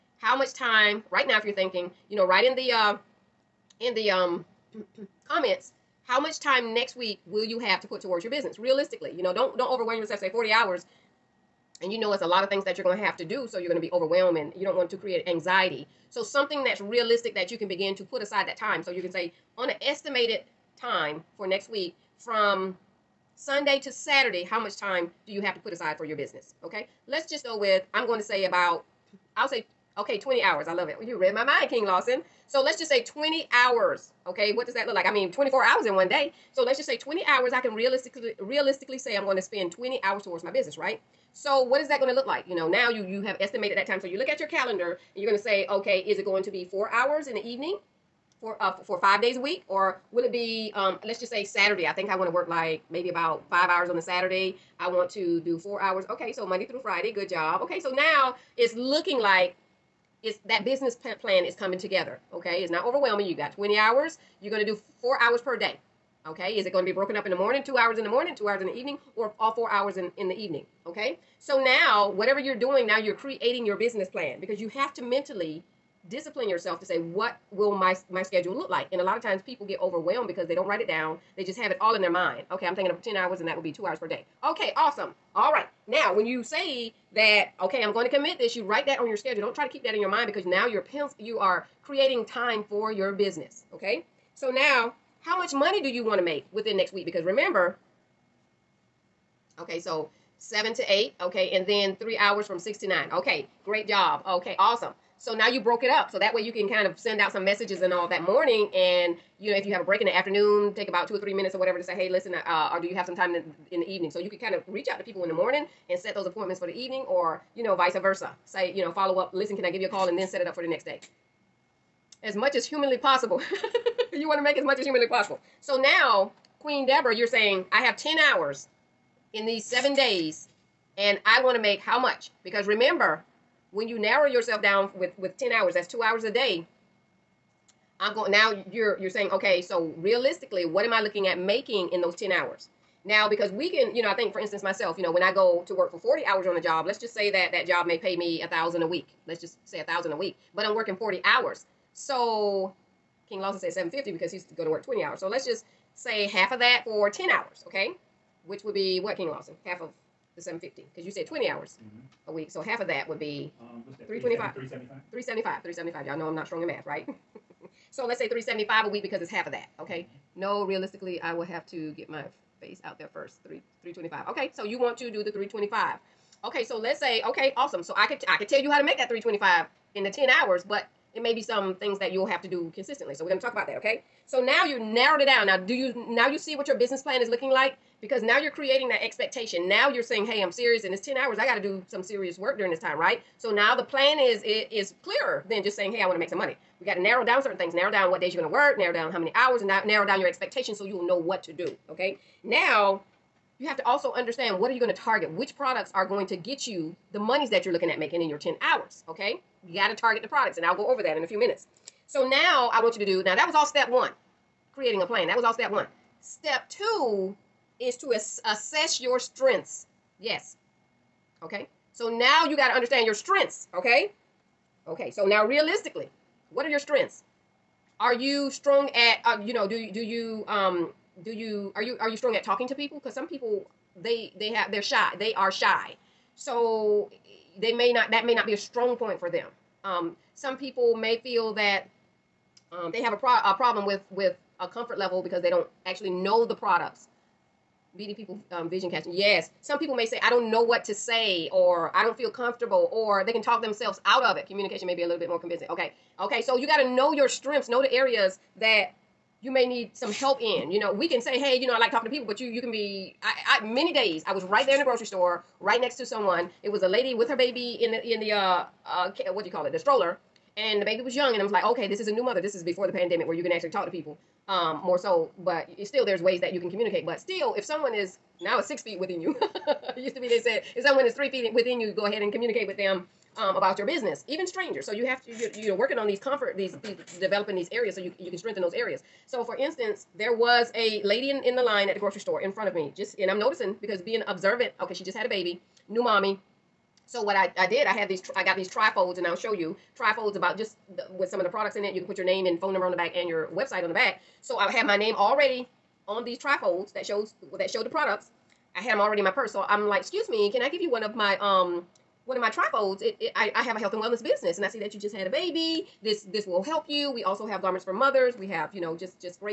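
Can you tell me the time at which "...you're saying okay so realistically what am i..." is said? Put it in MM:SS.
02:18.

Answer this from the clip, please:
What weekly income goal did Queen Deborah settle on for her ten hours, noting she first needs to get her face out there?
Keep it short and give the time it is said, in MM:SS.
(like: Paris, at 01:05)
325, at 02:53.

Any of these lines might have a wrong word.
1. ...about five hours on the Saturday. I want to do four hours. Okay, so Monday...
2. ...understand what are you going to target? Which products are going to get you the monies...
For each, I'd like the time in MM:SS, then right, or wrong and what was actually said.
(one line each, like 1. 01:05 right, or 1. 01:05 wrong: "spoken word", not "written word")
1. 00:53 right
2. 03:24 right.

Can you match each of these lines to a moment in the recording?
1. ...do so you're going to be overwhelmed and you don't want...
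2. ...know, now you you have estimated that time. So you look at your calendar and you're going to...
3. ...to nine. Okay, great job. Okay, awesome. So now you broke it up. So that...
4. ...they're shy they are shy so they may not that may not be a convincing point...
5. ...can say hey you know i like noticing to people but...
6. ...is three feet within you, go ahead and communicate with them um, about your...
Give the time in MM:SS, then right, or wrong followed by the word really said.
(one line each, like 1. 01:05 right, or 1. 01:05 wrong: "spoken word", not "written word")
1. 00:13 right
2. 00:42 right
3. 01:42 right
4. 03:54 wrong: "strong", not "convincing"
5. 04:21 wrong: "talking", not "noticing"
6. 04:41 right.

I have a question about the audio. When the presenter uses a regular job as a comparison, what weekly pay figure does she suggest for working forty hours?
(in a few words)
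1000.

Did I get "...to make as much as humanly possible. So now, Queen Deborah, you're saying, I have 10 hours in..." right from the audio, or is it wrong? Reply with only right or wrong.
right.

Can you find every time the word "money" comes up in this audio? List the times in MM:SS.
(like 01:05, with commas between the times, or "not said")
01:35, 03:16.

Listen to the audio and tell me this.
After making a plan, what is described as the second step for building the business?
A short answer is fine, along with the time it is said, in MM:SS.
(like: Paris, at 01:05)
Assess your strengths, at 03:38.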